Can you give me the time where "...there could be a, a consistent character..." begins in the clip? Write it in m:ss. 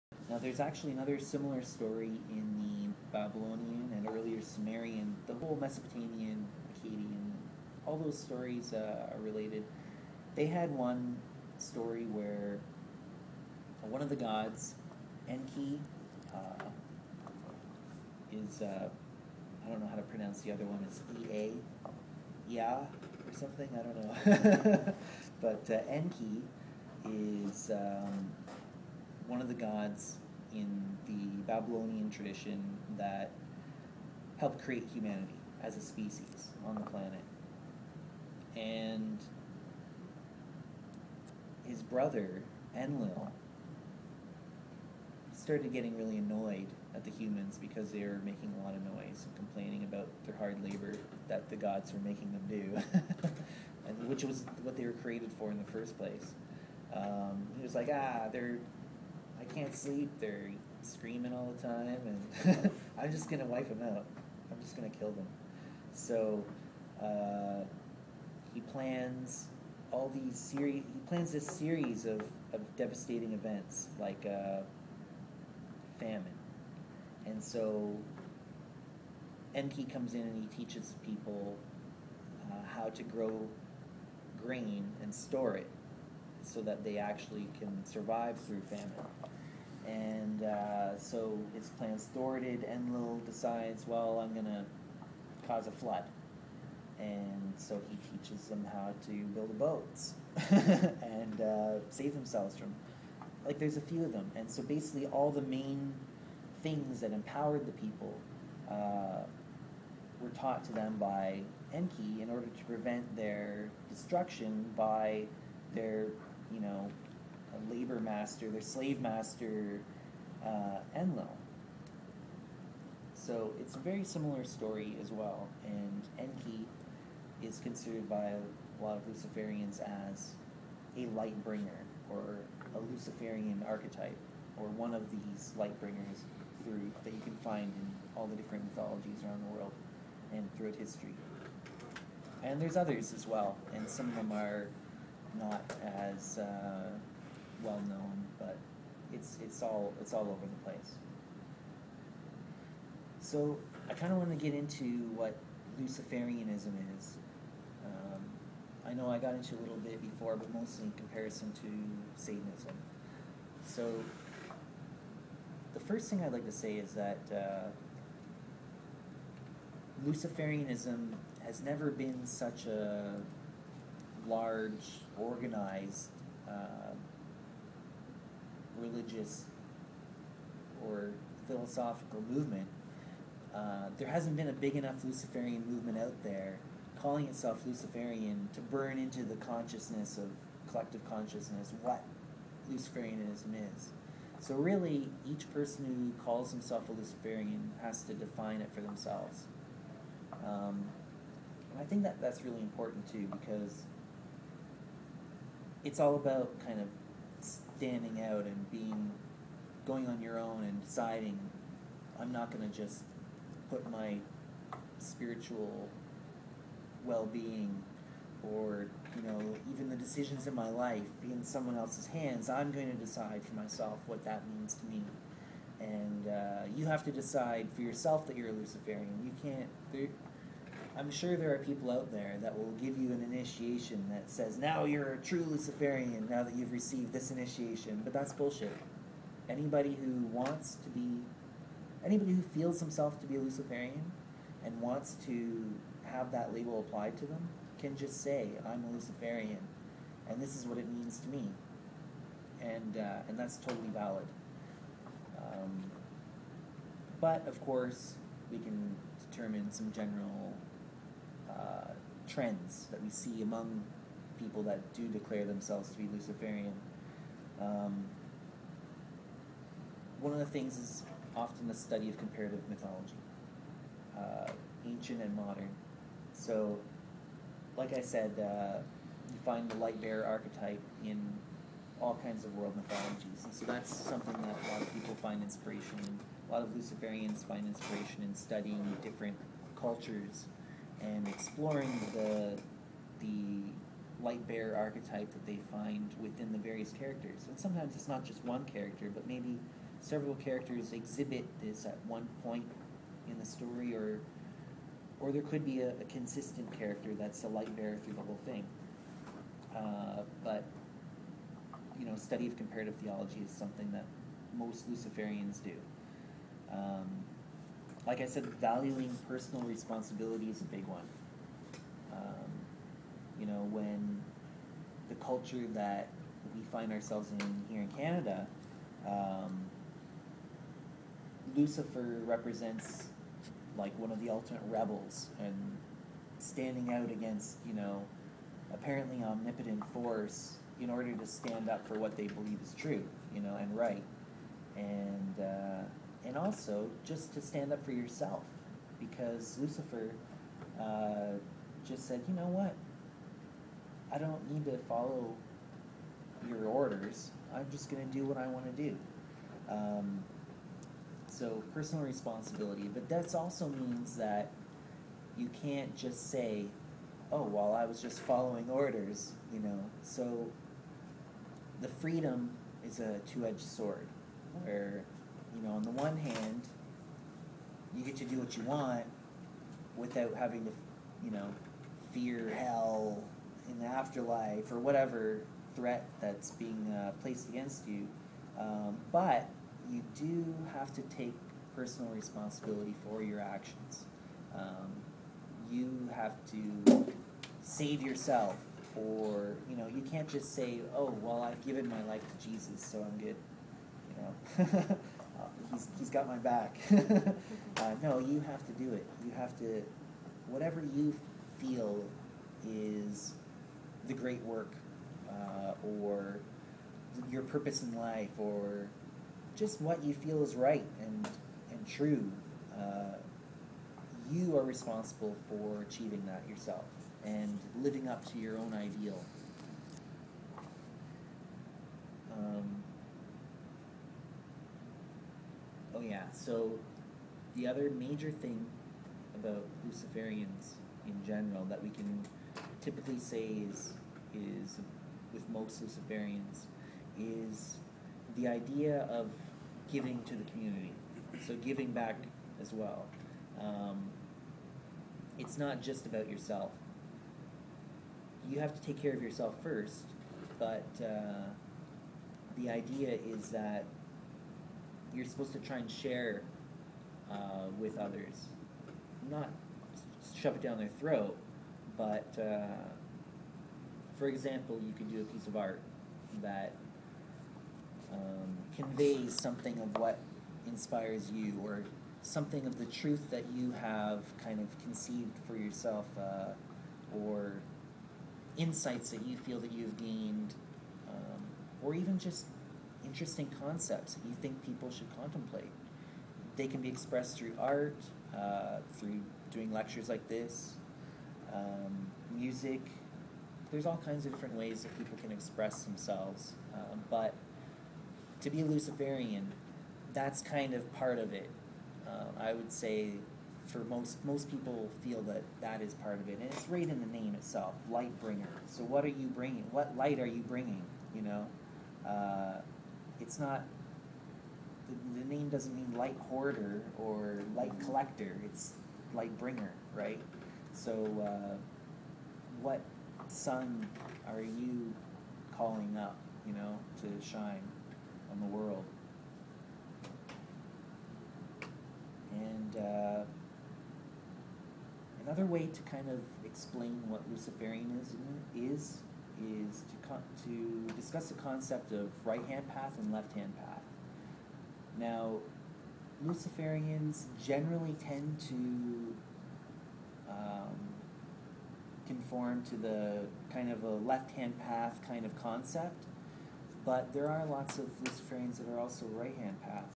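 5:05.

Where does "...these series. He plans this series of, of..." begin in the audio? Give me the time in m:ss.
1:10.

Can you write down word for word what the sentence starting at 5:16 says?
Um, like I said, valuing personal responsibility is a big one.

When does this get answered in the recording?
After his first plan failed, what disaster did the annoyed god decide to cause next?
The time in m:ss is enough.
1:35.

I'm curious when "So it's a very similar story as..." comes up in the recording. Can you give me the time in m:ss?
2:03.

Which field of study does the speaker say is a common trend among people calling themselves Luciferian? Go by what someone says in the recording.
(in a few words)
Comparative mythology.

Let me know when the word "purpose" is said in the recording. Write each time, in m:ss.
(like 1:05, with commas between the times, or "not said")
6:57.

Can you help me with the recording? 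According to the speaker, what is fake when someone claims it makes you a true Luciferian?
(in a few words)
An initiation.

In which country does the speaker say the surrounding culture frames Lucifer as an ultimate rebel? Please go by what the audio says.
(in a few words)
Canada.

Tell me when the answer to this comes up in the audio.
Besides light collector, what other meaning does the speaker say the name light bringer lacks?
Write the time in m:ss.
8:45.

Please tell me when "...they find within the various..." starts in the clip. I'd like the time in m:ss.
4:55.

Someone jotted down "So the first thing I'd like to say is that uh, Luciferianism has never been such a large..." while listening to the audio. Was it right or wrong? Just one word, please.
right.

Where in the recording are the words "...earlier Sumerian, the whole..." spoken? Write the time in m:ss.
0:04.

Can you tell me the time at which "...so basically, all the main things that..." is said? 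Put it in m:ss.
1:44.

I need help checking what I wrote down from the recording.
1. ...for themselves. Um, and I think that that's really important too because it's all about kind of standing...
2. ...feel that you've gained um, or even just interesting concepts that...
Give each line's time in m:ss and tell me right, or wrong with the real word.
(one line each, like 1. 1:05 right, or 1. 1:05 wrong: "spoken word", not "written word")
1. 3:18 right
2. 8:09 right.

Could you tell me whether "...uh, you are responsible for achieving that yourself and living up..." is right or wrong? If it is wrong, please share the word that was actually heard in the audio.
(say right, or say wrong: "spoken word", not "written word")
right.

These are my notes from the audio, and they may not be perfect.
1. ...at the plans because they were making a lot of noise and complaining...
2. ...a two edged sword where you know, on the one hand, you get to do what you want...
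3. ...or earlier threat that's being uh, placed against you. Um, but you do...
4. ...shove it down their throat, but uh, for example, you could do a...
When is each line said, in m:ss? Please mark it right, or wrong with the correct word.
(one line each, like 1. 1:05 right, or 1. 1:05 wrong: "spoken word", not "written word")
1. 0:46 wrong: "humans", not "plans"
2. 6:12 right
3. 6:24 wrong: "whatever", not "earlier"
4. 7:50 right.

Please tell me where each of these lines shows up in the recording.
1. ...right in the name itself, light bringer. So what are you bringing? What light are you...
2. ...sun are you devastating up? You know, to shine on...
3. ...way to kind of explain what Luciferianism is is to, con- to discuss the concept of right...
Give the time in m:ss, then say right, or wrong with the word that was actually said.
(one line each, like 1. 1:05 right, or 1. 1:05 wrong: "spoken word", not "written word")
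1. 8:36 right
2. 8:53 wrong: "calling", not "devastating"
3. 9:05 right.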